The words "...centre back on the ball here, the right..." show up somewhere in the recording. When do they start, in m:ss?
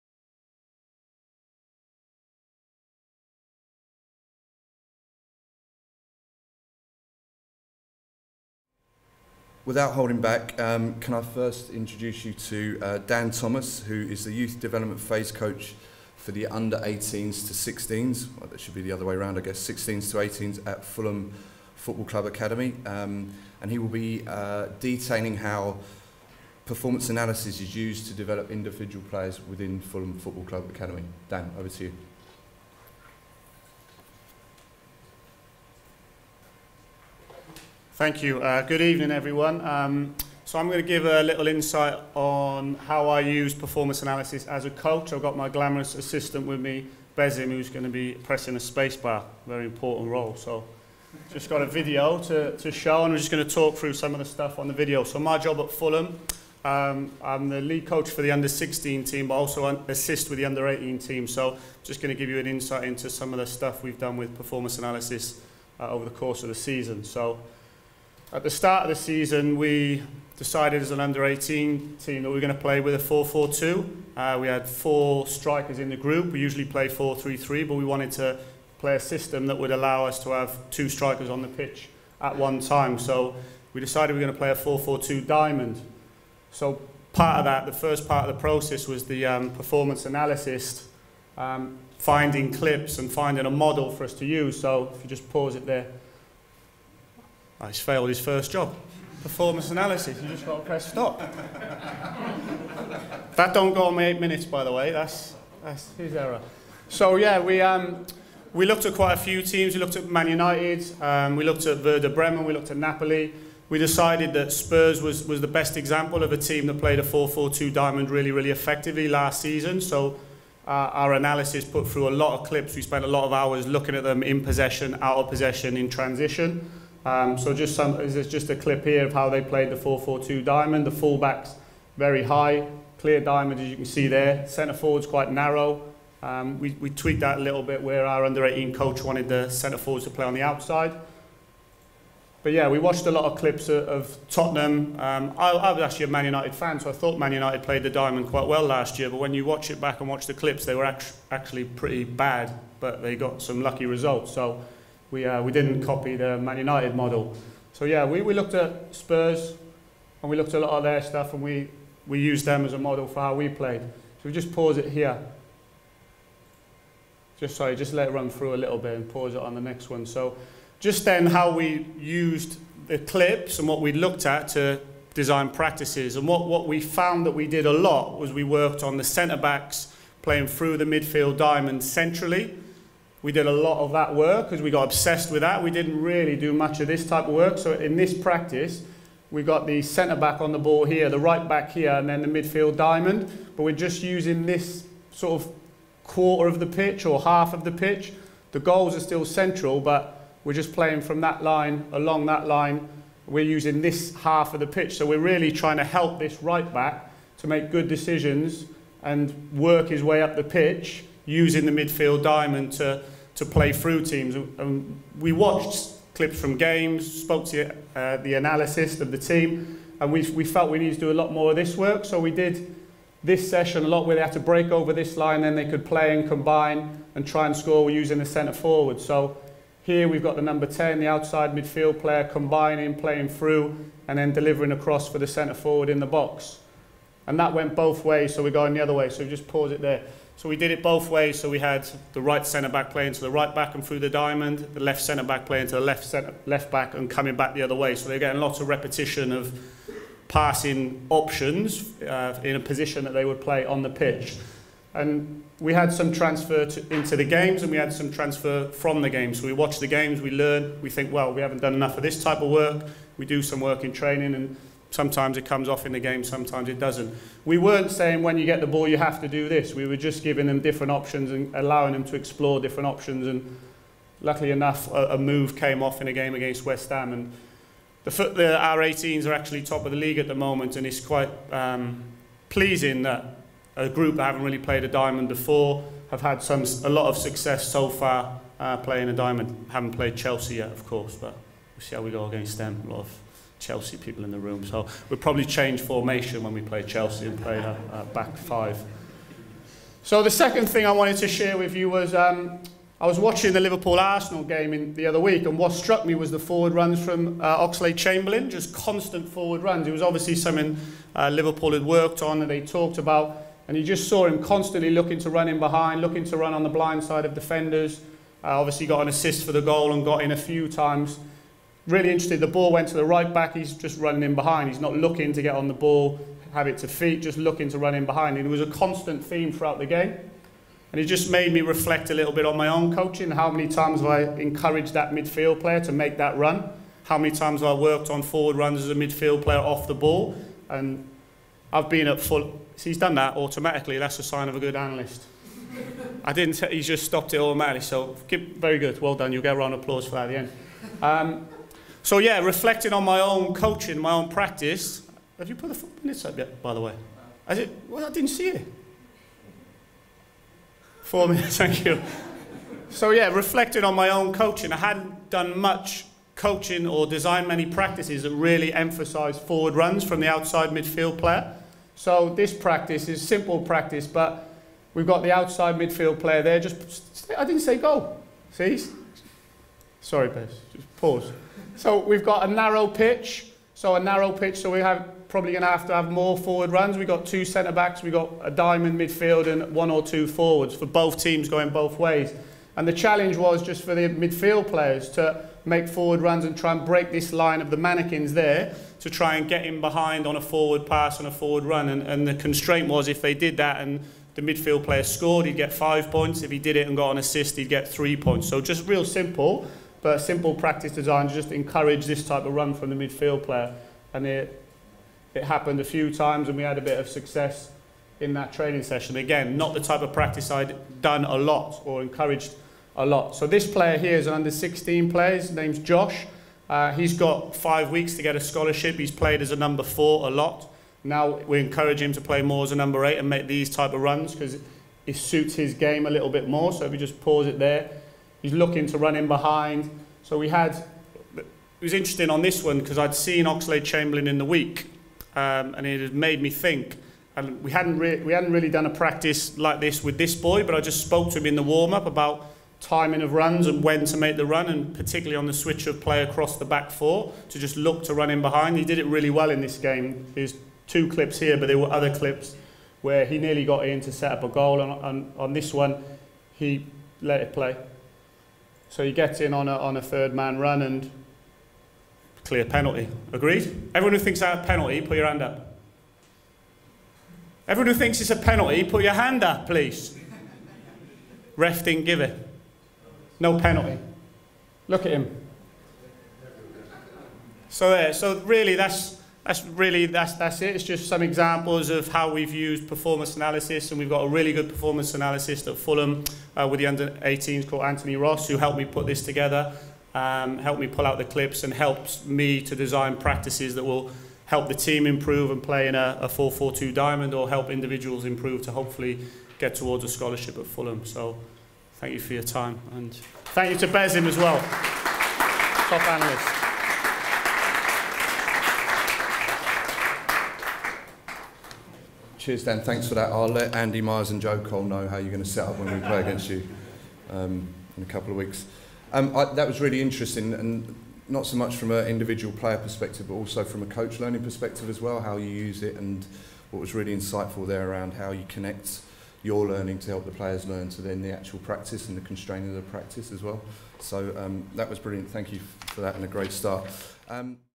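3:09.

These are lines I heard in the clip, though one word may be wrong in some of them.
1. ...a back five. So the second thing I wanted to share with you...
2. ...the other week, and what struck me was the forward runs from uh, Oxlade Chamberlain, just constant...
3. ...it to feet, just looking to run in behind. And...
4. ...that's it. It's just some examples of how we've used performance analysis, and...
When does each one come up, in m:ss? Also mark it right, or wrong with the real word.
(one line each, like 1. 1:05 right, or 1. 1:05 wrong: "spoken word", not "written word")
1. 4:57 right
2. 5:04 right
3. 5:26 right
4. 8:10 right.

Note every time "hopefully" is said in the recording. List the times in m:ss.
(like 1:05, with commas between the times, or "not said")
8:28.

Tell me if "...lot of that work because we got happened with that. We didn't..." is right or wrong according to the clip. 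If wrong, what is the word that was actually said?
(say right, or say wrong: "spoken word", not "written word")
wrong: "obsessed", not "happened".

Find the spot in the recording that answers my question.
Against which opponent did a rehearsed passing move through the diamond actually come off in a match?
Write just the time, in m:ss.
4:36.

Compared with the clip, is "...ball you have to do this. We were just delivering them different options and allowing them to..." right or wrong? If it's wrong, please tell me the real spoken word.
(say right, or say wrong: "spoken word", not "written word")
wrong: "giving", not "delivering".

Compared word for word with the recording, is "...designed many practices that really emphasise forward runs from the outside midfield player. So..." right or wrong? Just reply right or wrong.
right.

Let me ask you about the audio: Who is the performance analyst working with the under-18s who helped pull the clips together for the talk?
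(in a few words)
Anthony Ross.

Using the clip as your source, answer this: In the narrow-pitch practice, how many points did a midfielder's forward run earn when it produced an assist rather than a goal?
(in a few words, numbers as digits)
3.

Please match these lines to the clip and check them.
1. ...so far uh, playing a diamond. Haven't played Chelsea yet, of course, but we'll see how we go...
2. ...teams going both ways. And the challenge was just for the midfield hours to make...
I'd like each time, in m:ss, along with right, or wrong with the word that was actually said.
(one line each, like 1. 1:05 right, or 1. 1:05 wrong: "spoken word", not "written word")
1. 4:47 right
2. 6:31 wrong: "players", not "hours".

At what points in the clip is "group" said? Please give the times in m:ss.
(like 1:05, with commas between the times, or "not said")
1:15, 4:43.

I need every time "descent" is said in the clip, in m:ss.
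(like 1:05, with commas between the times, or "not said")
not said.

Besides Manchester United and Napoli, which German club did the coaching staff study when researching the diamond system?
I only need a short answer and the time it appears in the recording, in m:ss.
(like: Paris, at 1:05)
Werder Bremen, at 1:51.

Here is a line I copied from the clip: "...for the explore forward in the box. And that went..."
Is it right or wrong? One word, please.
wrong.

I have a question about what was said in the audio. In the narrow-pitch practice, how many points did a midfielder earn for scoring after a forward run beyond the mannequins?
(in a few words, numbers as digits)
5.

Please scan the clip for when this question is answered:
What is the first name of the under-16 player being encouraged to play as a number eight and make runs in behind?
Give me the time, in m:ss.
7:05.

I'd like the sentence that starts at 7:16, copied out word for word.
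So if we just pause it there, He's looking to run in behind.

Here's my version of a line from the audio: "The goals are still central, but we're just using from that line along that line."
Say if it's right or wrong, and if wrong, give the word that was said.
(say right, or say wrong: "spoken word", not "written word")
wrong: "playing", not "using".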